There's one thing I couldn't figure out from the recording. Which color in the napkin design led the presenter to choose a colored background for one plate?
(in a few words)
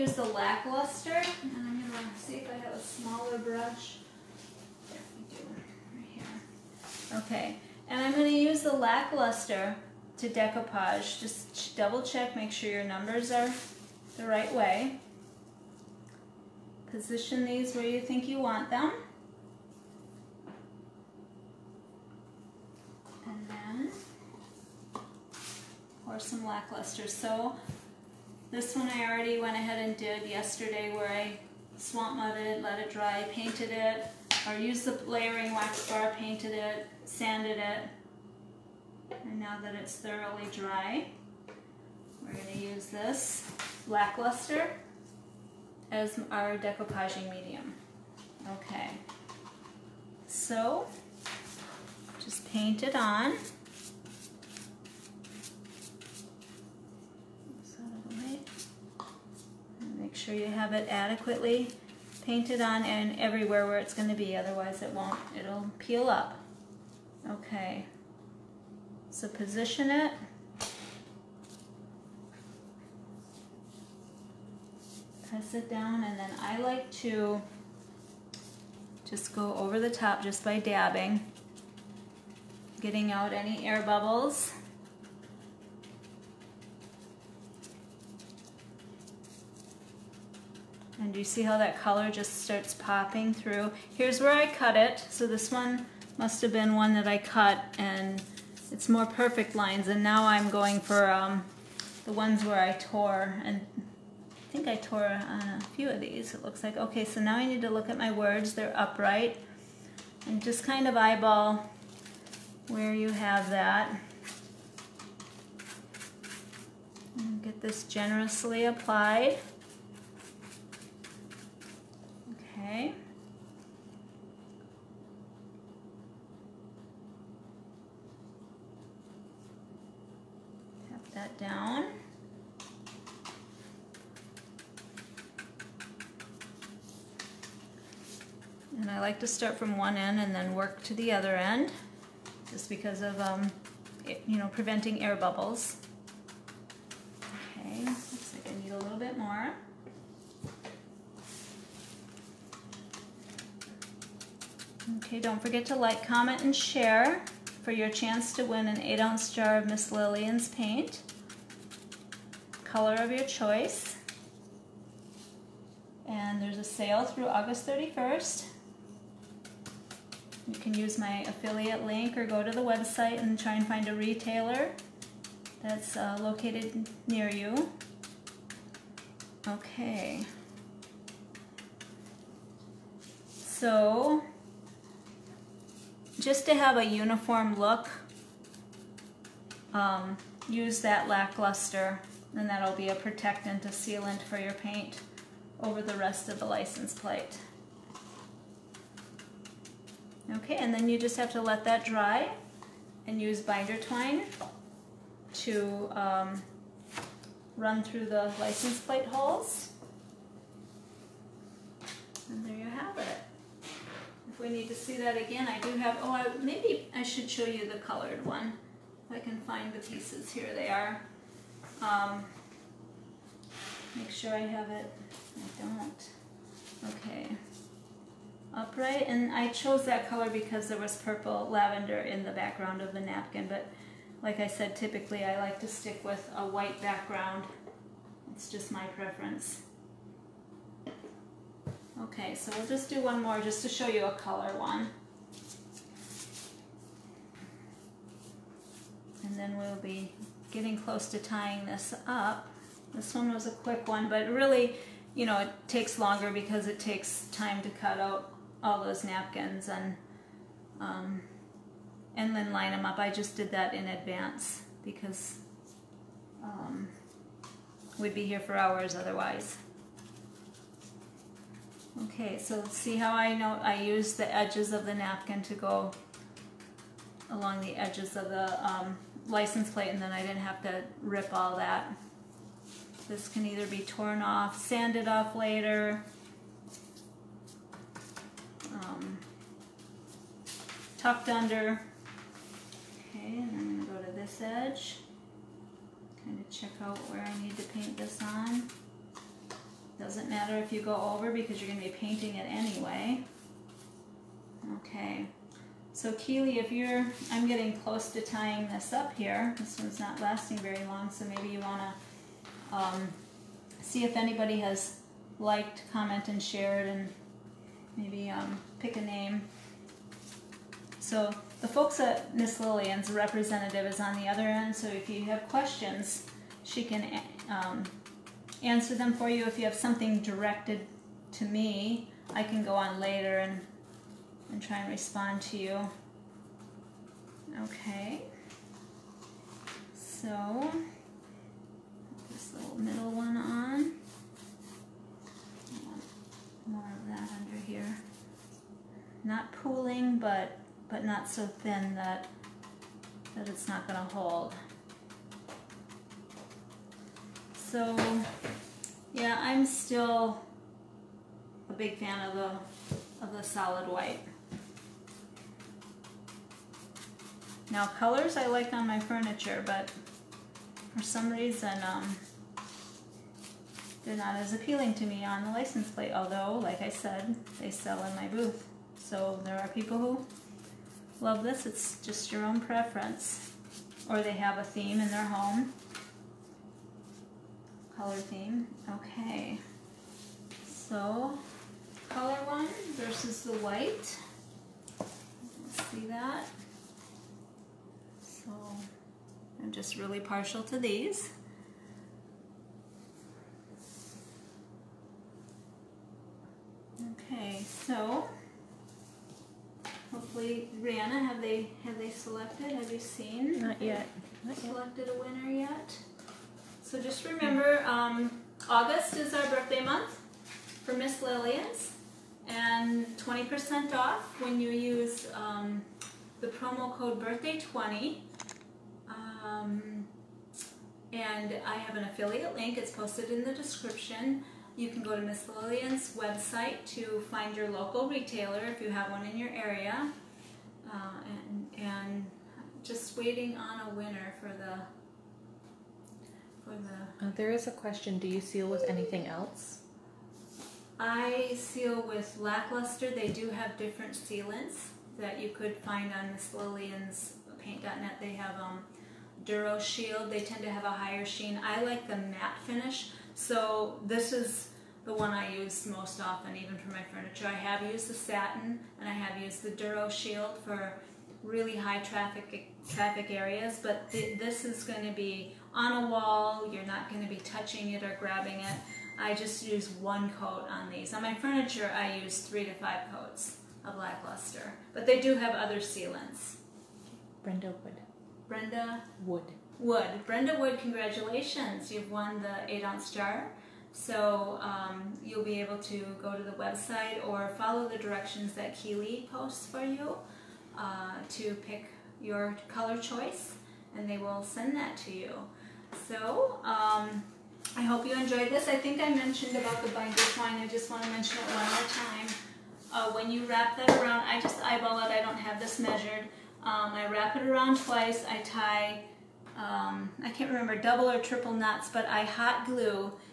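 Purple lavender.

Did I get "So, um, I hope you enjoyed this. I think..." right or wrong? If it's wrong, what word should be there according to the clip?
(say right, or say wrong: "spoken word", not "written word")
right.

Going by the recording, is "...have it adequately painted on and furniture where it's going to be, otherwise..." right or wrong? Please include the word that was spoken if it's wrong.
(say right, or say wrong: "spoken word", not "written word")
wrong: "everywhere", not "furniture".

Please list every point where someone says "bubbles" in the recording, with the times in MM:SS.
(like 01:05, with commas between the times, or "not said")
01:23, 02:25.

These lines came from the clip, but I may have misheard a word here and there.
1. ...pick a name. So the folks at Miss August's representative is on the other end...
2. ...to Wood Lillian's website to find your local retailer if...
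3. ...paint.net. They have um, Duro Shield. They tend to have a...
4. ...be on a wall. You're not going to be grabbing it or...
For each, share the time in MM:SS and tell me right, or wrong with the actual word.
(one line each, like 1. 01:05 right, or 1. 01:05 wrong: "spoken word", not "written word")
1. 05:18 wrong: "Lillian", not "August"
2. 07:15 wrong: "Miss", not "Wood"
3. 07:37 right
4. 07:55 wrong: "touching", not "grabbing".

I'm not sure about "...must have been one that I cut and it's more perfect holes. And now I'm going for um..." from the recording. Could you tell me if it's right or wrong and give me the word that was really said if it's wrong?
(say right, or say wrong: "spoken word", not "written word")
wrong: "lines", not "holes".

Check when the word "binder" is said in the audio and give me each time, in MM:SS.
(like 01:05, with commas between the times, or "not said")
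03:23, 08:29.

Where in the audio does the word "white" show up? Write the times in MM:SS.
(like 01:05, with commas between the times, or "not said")
03:56, 06:03, 06:33.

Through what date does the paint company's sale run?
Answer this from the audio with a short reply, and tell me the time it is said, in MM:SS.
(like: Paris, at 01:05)
August 31st, at 02:47.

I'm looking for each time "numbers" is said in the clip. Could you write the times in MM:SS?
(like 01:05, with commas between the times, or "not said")
00:12.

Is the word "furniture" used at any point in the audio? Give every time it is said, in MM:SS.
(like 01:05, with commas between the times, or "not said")
06:08, 07:47, 08:01.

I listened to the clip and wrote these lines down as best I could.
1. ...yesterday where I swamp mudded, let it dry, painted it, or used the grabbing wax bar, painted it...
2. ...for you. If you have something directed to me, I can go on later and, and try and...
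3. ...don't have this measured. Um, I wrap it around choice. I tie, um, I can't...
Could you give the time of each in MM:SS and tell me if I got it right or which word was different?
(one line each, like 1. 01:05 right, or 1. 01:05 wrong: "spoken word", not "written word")
1. 00:30 wrong: "layering", not "grabbing"
2. 05:29 right
3. 08:35 wrong: "twice", not "choice".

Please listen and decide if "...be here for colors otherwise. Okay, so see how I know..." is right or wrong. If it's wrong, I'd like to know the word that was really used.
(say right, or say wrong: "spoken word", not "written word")
wrong: "hours", not "colors".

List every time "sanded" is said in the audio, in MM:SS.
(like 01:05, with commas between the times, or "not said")
00:37, 04:44.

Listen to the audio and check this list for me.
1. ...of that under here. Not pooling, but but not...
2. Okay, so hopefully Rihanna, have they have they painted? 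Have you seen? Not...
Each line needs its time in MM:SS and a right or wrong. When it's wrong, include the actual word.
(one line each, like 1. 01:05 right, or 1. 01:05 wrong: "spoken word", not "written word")
1. 05:47 right
2. 06:47 wrong: "selected", not "painted".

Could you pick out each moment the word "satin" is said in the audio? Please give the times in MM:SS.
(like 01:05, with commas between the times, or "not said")
07:48.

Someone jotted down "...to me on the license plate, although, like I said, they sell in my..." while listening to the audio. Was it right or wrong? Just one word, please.
right.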